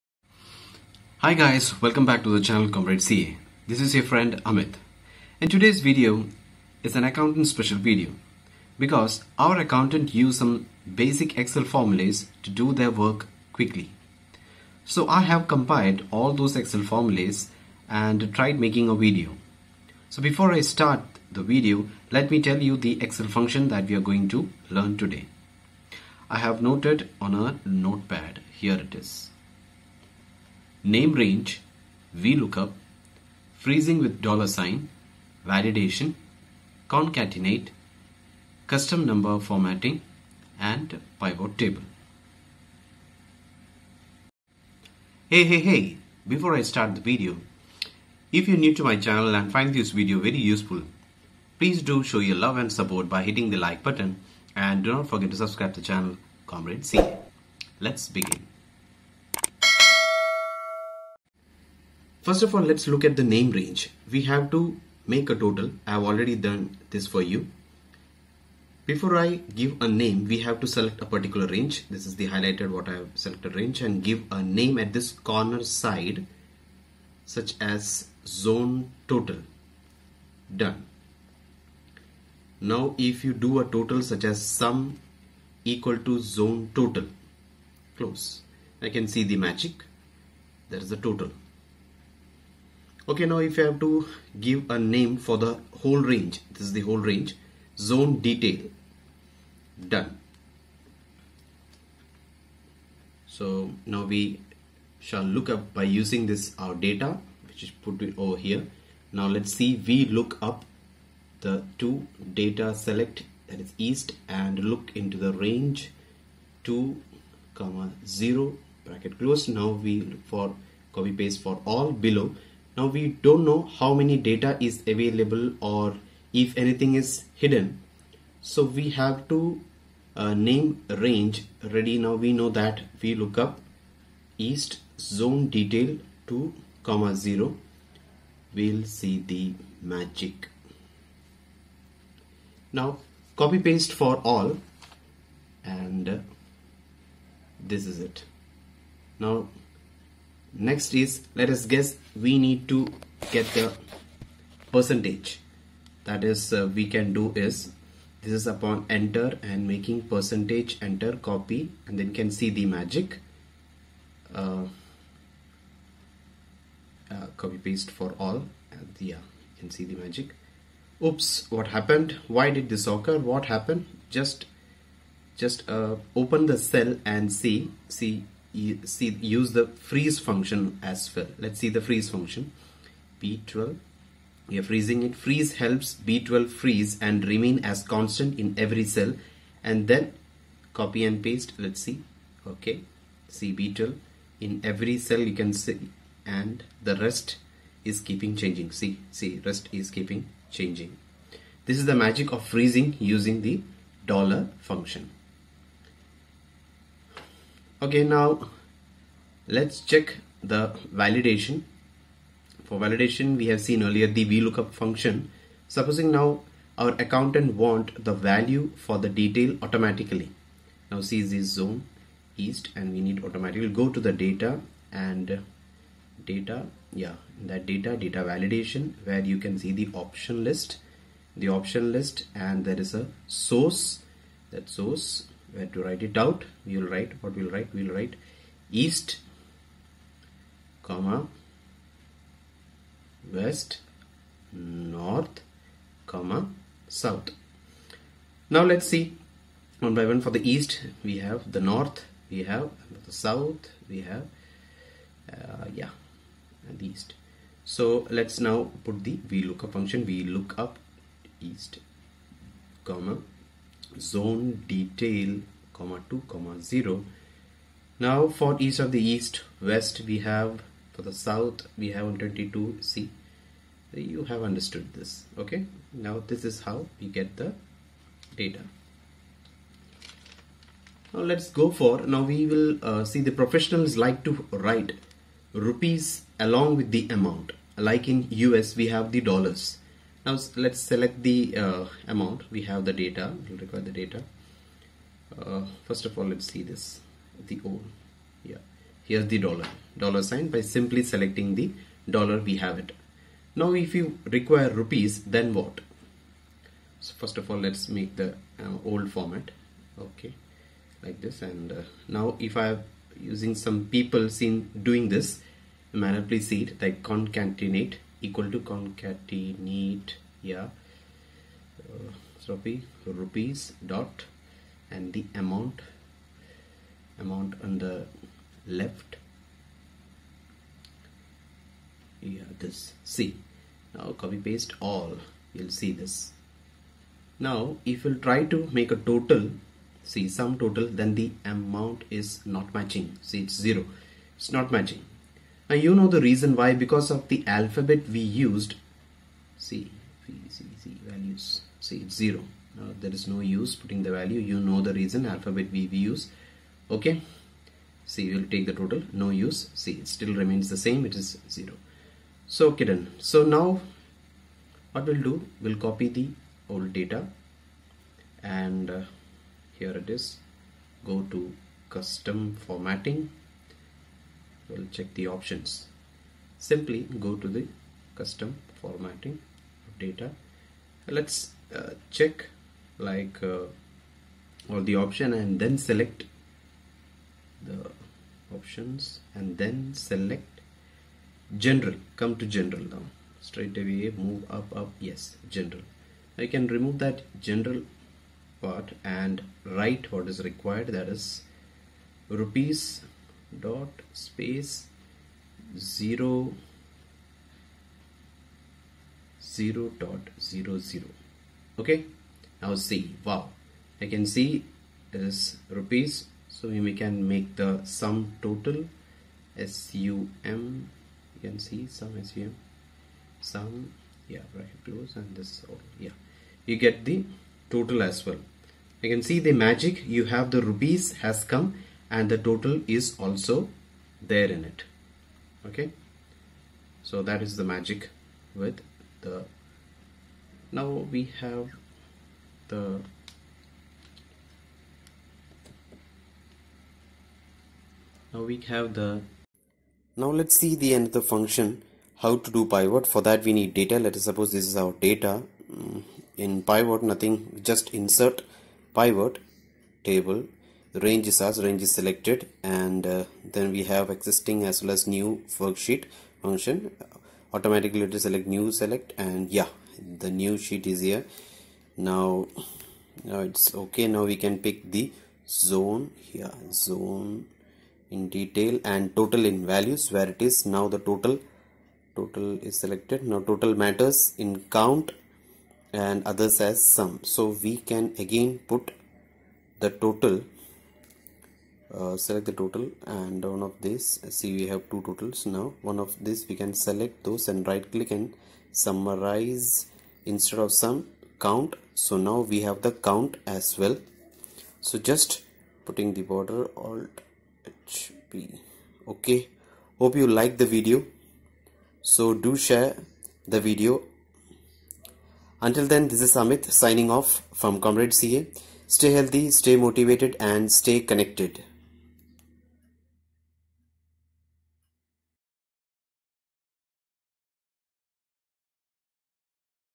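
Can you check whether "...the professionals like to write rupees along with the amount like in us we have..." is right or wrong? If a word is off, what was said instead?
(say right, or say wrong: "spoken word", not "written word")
right.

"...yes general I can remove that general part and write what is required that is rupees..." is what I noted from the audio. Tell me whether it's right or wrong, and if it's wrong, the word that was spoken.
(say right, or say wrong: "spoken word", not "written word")
right.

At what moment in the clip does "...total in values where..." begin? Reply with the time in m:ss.
7:59.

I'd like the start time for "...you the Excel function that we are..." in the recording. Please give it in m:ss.
0:22.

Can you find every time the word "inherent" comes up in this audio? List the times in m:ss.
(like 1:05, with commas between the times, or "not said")
not said.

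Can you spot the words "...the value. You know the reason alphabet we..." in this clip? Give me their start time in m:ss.
5:54.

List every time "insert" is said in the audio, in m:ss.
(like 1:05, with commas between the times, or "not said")
7:38.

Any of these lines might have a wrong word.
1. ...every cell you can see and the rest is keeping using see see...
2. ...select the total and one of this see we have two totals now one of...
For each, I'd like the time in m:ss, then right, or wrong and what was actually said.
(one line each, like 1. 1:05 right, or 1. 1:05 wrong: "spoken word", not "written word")
1. 3:14 wrong: "changing", not "using"
2. 8:12 right.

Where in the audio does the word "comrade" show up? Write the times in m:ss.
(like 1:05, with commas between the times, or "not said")
0:02, 0:56, 8:37.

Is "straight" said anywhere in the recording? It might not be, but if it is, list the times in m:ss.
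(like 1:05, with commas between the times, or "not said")
6:33.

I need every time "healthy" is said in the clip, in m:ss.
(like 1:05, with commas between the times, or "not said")
8:39.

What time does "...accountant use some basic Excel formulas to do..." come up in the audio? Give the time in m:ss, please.
0:09.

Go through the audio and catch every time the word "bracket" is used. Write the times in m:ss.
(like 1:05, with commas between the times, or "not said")
1:58, 7:04.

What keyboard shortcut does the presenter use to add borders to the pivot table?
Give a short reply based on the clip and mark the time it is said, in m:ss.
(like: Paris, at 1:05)
Alt HP, at 8:26.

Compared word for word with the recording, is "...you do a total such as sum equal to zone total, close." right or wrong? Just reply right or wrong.
right.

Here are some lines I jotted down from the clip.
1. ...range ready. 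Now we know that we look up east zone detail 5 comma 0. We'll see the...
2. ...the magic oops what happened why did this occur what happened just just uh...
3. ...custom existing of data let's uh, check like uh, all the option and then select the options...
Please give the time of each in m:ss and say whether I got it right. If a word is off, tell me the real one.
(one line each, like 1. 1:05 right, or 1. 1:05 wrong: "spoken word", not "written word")
1. 2:10 wrong: "2", not "5"
2. 2:49 right
3. 6:18 wrong: "formatting", not "existing".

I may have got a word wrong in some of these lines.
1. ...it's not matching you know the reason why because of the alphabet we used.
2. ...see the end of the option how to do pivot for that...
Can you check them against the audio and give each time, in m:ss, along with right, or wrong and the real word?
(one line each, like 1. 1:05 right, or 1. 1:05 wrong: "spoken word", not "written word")
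1. 5:44 right
2. 7:30 wrong: "function", not "option".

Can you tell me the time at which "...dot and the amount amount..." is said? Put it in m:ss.
5:23.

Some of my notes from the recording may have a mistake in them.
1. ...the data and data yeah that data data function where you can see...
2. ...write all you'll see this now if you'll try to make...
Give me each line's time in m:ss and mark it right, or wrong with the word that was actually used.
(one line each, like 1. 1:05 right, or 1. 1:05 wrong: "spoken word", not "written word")
1. 3:43 wrong: "validation", not "function"
2. 5:34 wrong: "paste", not "write".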